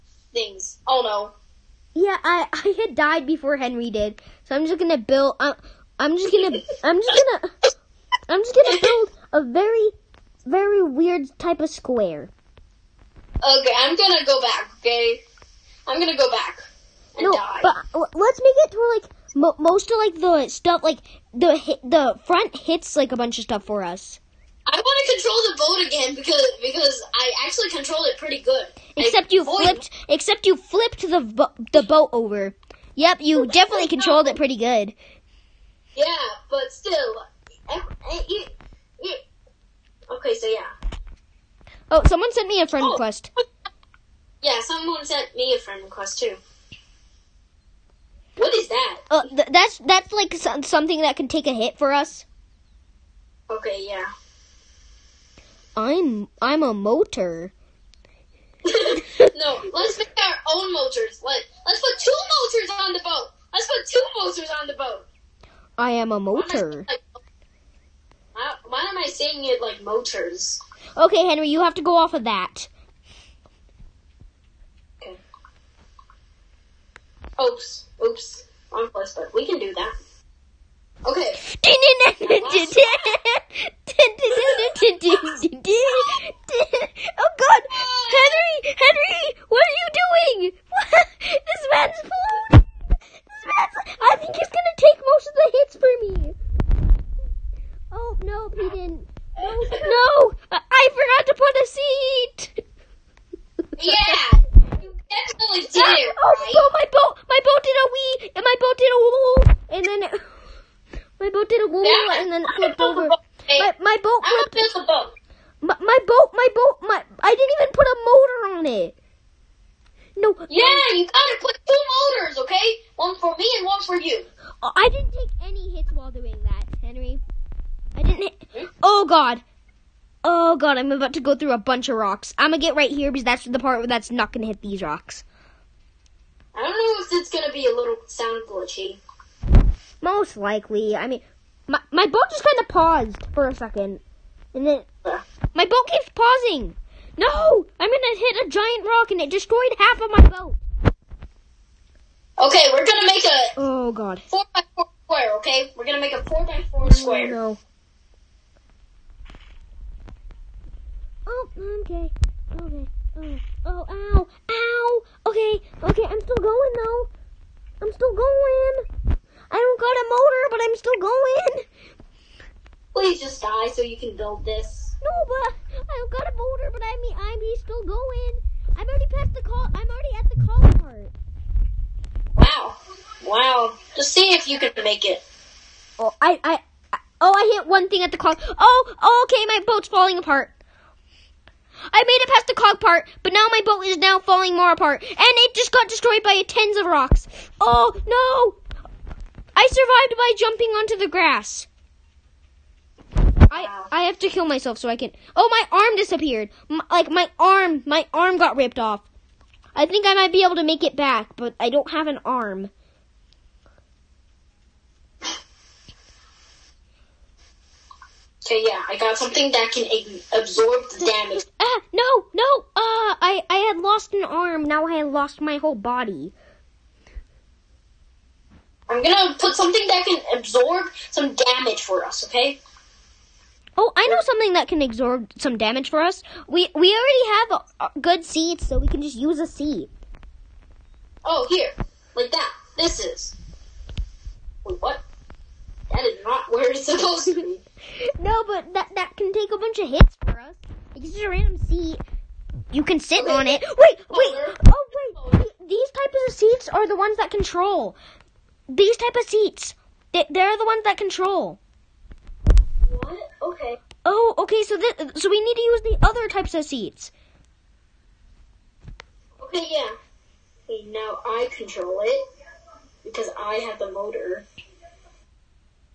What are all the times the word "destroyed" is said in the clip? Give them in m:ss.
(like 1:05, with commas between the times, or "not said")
2:29, 3:15.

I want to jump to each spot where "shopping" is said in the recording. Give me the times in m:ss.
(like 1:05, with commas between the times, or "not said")
not said.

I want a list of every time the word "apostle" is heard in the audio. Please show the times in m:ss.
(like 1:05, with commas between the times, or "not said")
not said.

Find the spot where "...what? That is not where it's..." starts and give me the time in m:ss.
4:04.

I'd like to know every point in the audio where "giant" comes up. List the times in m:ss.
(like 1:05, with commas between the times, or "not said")
2:28.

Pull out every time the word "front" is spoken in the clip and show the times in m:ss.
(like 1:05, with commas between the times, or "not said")
0:22.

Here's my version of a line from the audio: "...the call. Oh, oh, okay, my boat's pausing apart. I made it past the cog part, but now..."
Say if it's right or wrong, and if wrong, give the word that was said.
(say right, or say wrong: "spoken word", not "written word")
wrong: "falling", not "pausing".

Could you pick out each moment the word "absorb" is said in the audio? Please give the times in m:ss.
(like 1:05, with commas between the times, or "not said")
3:40, 3:50, 3:54.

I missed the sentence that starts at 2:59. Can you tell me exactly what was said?
I'm already at the call part.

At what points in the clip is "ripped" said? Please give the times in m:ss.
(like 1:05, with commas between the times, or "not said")
3:28.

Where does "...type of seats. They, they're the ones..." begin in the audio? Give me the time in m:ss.
4:18.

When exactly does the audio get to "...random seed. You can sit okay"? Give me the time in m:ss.
4:11.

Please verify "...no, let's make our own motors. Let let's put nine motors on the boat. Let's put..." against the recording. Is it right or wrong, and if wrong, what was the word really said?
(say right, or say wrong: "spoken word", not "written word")
wrong: "two", not "nine".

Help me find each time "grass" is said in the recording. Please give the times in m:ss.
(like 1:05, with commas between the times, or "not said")
3:21.